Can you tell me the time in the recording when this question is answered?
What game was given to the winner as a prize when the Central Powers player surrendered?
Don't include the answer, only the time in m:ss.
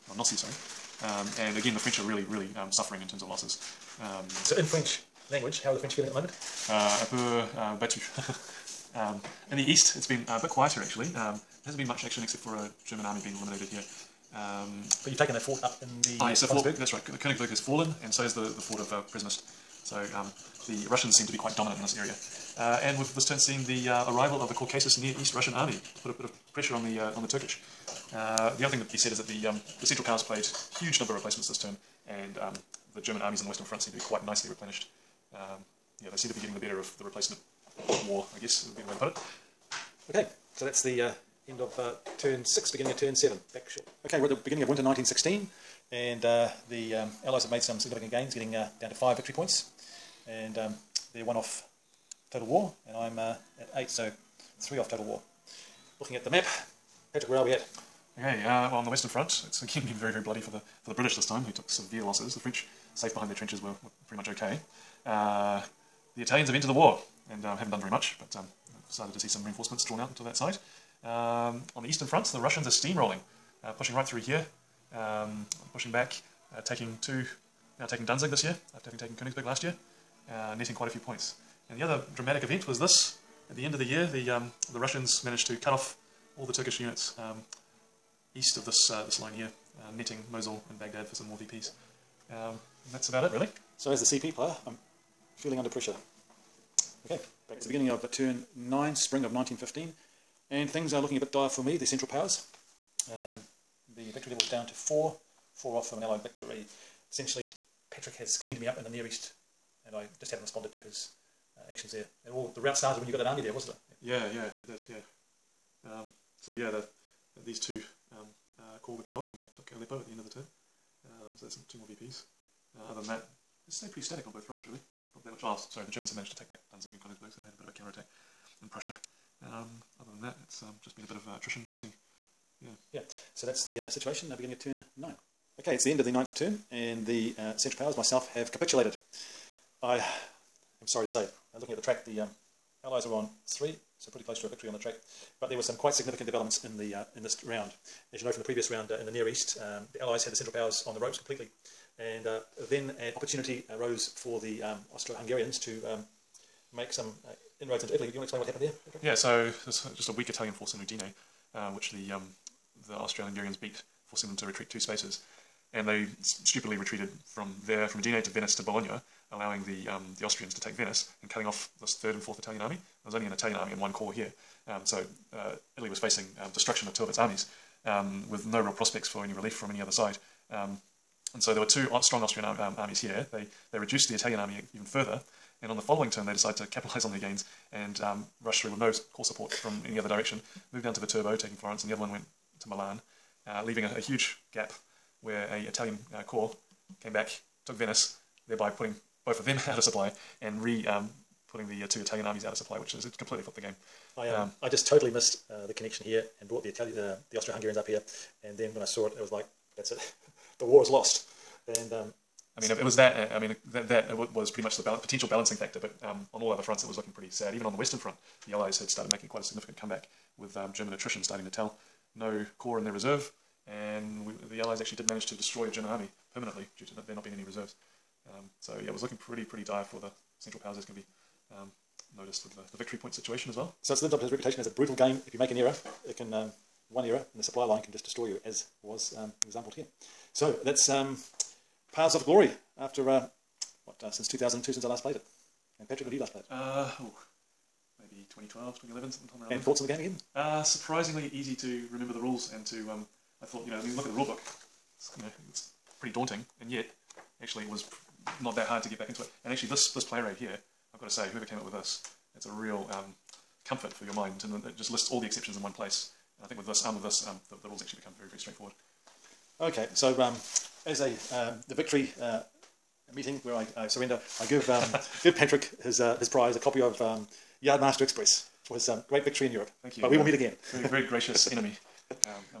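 4:37.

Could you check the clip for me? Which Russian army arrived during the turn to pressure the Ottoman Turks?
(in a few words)
Caucasus Near East Russian Army.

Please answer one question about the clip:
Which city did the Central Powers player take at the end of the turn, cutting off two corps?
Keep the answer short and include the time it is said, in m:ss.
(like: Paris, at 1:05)
Aleppo, at 1:59.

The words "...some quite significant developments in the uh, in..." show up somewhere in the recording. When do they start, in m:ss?
2:25.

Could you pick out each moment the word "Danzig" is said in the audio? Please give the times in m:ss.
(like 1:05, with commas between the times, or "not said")
1:18, 2:06.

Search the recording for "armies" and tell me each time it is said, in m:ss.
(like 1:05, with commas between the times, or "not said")
0:33, 2:57, 3:02, 3:22.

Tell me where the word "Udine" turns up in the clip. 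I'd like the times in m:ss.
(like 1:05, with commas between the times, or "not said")
2:40, 2:47.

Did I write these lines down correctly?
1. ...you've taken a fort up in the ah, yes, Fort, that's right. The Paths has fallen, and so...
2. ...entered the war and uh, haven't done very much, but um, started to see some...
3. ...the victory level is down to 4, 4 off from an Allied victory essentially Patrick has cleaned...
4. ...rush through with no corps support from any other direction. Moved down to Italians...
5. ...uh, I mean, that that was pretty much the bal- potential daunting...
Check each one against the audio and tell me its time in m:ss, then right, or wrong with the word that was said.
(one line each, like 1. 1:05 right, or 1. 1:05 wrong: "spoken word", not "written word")
1. 0:15 wrong: "Königsberg", not "Paths"
2. 1:06 right
3. 1:43 right
4. 3:08 wrong: "Viterbo", not "Italians"
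5. 3:33 wrong: "balancing", not "daunting".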